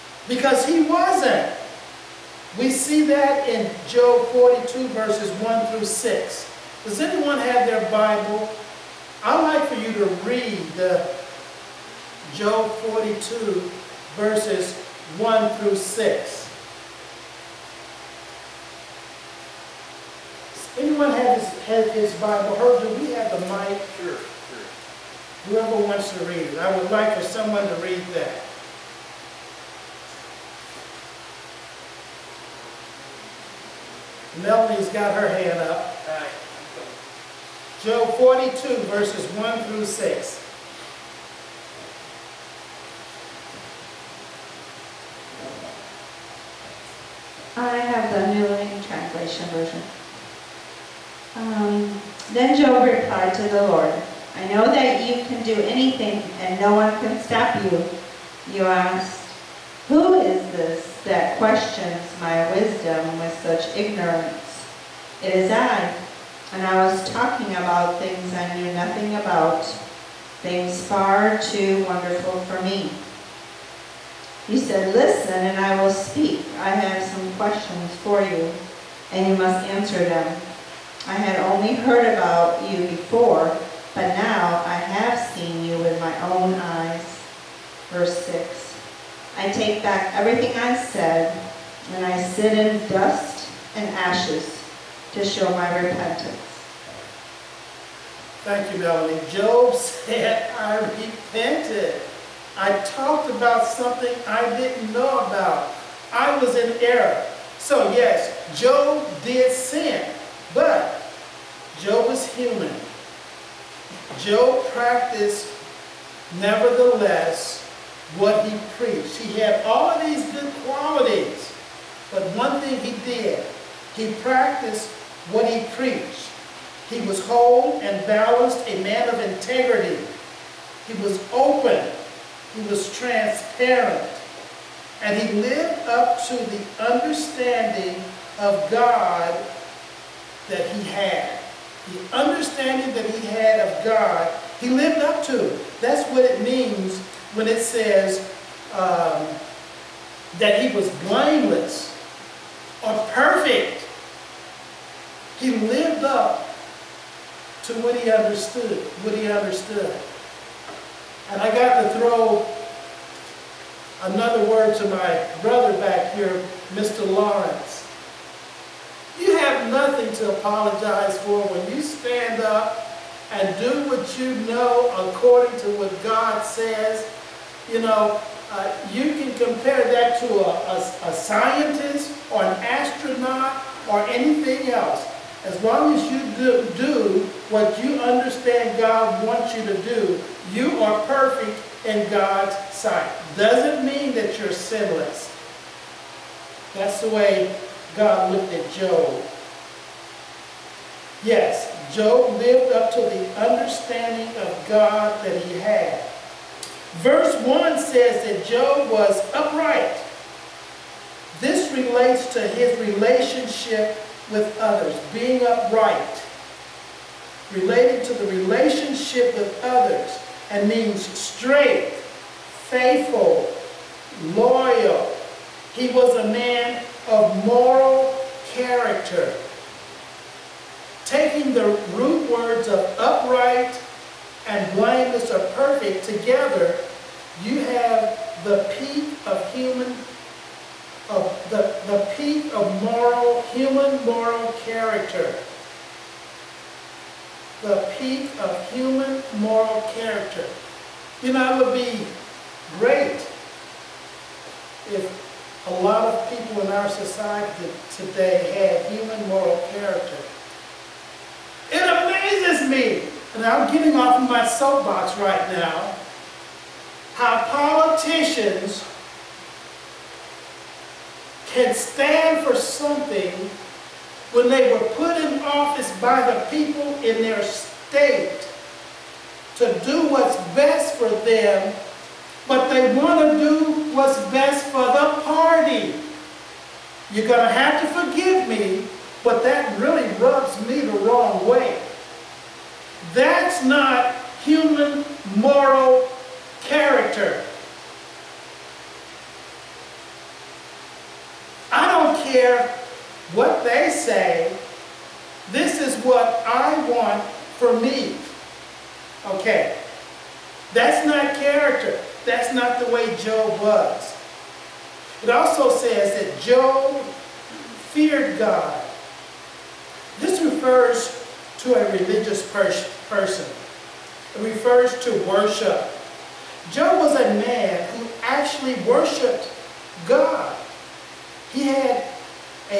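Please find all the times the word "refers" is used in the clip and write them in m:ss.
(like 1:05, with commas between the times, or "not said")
5:20, 5:24.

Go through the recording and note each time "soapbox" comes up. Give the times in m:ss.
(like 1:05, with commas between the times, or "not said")
4:24.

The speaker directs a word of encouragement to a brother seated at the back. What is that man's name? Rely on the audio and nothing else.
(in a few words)
Mr. Lawrence.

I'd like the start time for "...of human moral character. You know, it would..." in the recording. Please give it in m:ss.
4:08.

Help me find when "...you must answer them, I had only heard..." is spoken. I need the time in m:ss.
1:19.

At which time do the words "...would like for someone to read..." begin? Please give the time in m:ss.
0:26.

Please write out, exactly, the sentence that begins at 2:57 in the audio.
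You know, uh, you can compare that to a, a, a scientist or an astronaut or anything else.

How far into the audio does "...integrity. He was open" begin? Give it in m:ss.
2:09.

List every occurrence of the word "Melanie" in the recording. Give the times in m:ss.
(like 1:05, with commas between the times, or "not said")
0:34, 1:38.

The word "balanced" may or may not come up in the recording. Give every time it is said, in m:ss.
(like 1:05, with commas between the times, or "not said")
2:08.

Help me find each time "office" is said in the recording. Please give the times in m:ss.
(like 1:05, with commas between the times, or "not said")
4:35.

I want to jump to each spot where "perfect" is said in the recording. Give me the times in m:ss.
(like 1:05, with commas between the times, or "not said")
2:33, 3:11, 3:55.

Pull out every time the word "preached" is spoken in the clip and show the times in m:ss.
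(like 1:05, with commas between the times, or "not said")
1:58, 2:05.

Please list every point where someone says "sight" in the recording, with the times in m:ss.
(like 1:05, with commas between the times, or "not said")
3:12.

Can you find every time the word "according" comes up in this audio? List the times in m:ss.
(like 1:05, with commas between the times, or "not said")
2:55.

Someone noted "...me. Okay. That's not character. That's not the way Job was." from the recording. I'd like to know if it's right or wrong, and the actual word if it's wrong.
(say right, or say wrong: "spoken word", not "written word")
right.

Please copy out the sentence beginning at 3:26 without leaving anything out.
Verse 1 says that Job was upright.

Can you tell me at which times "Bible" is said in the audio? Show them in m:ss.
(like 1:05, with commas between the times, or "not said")
0:07, 0:22.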